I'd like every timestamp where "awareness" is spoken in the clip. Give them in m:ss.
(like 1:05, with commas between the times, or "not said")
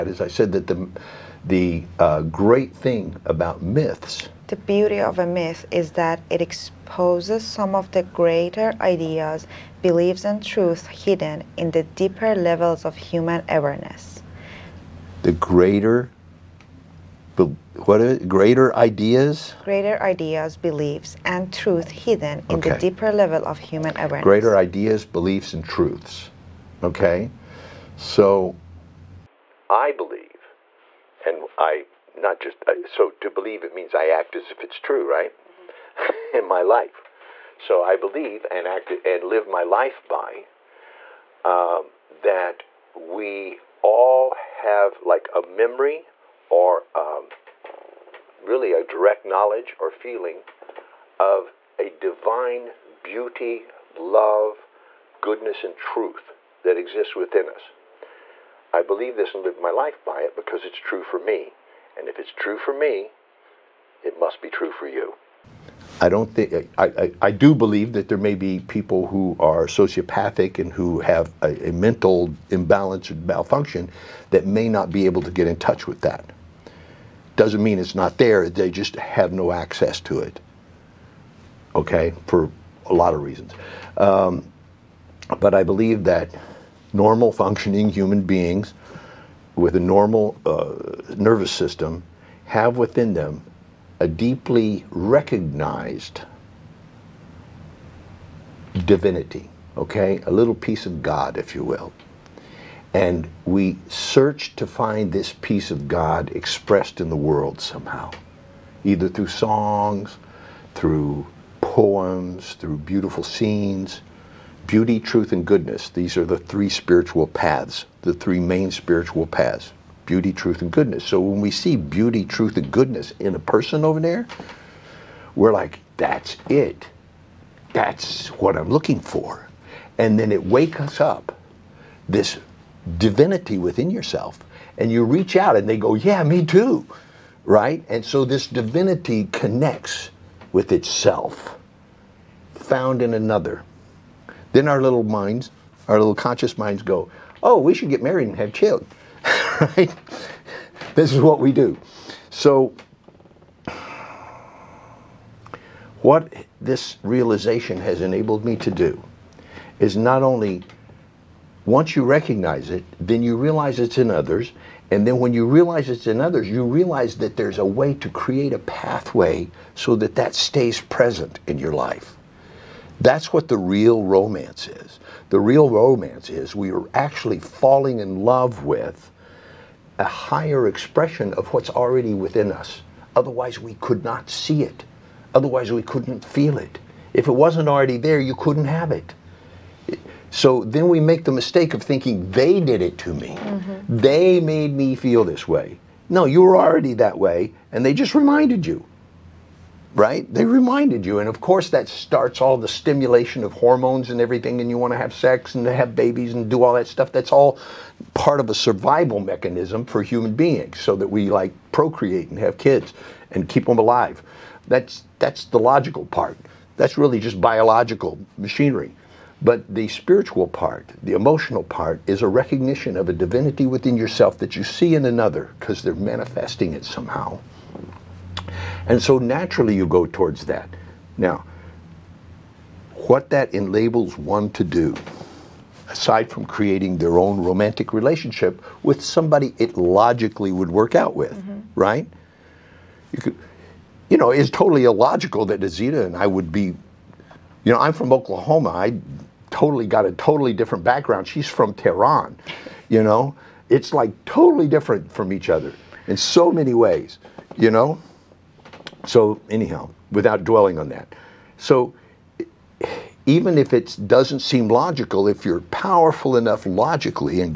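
0:13, 0:23.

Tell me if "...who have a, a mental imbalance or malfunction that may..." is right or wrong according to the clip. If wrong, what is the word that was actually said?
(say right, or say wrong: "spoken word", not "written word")
right.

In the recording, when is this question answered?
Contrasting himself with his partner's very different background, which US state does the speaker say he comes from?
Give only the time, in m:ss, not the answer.
4:08.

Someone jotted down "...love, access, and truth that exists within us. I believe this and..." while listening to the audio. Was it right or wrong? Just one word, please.
wrong.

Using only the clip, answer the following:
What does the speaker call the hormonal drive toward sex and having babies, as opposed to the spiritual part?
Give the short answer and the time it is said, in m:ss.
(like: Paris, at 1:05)
Biological machinery, at 3:37.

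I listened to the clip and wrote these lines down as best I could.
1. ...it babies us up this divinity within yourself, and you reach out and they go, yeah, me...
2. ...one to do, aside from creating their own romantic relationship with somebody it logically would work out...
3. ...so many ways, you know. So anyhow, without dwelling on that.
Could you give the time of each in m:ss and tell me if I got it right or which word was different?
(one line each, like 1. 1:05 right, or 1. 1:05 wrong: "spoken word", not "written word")
1. 2:10 wrong: "wakes", not "babies"
2. 3:54 right
3. 4:16 right.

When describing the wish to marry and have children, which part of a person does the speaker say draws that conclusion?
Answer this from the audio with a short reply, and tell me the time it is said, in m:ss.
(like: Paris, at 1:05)
Little conscious minds, at 2:25.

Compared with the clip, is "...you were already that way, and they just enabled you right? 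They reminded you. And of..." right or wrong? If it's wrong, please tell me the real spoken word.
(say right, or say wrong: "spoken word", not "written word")
wrong: "reminded", not "enabled".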